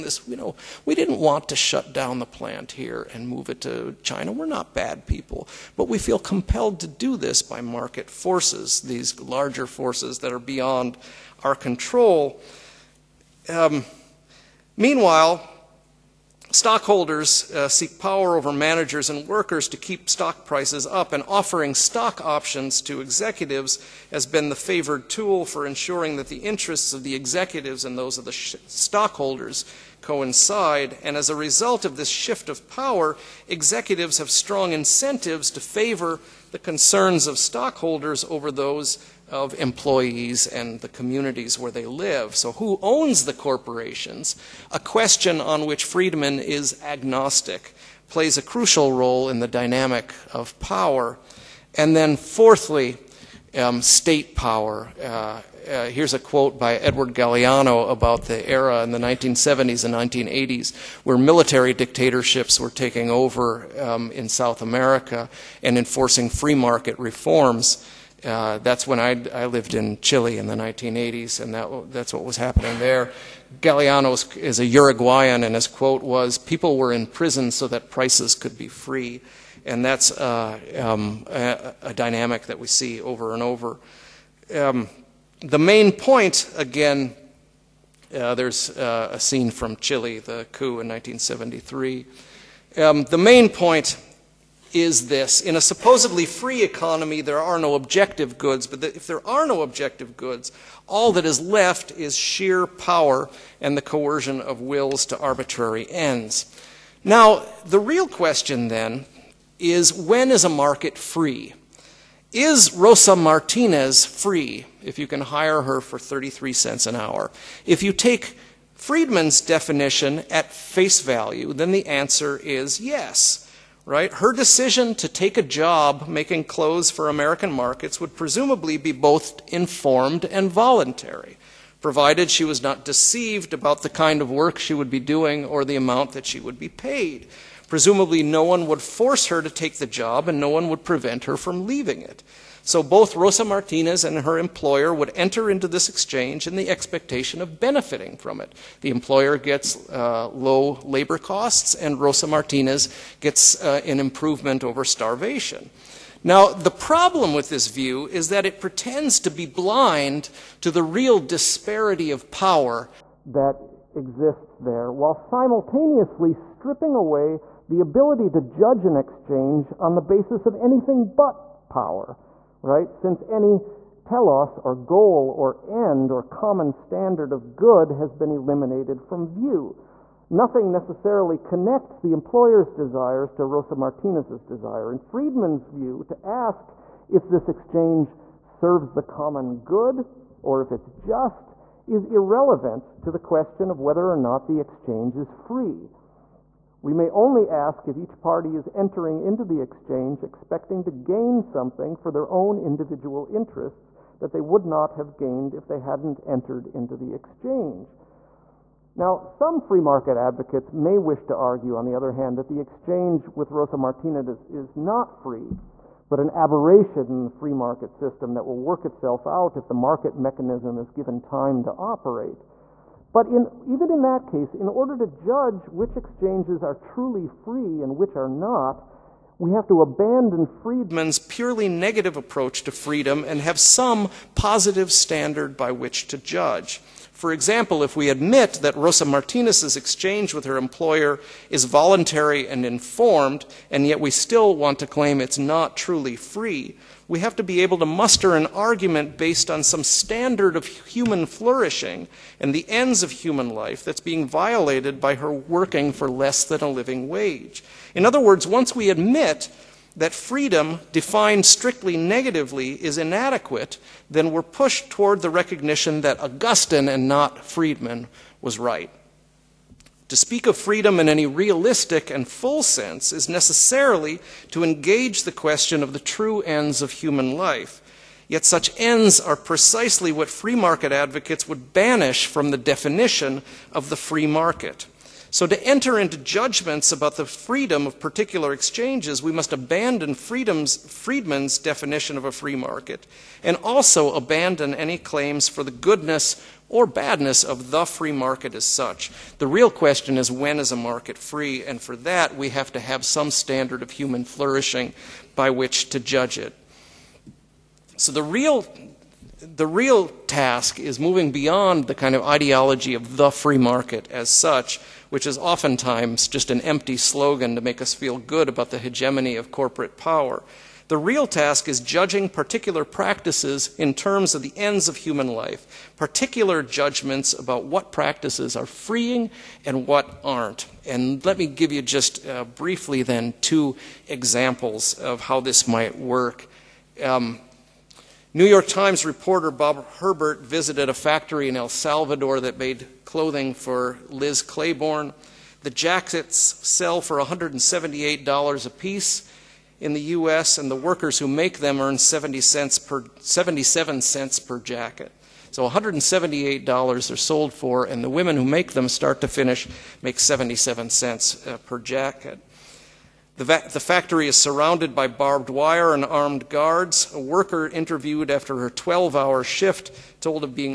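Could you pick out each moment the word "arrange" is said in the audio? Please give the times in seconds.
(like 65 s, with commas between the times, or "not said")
not said.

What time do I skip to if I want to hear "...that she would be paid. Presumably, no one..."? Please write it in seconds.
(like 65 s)
136 s.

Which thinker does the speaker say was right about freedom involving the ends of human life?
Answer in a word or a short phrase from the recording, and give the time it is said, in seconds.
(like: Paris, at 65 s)
Augustine, at 266 s.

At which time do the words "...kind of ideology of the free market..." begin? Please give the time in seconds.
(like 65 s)
311 s.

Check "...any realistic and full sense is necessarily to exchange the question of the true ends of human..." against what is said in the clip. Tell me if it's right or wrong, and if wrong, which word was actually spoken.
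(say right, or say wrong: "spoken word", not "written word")
wrong: "engage", not "exchange".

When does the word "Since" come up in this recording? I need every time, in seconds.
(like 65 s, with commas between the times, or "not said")
172 s.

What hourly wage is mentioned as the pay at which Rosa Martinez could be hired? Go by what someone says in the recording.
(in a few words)
33 cents.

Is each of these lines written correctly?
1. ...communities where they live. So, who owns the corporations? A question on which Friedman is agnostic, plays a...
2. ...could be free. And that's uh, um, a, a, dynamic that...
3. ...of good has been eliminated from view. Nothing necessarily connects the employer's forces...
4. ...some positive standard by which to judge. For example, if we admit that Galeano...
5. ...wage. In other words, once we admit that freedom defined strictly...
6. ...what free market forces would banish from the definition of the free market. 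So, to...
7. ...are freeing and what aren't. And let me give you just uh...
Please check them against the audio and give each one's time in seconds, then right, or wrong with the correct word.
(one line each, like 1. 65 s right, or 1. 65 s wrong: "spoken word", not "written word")
1. 40 s right
2. 78 s right
3. 177 s wrong: "desires", not "forces"
4. 233 s wrong: "Rosa", not "Galeano"
5. 257 s right
6. 280 s wrong: "advocates", not "forces"
7. 328 s right.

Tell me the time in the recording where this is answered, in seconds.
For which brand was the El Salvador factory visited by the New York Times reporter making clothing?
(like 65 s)
344 s.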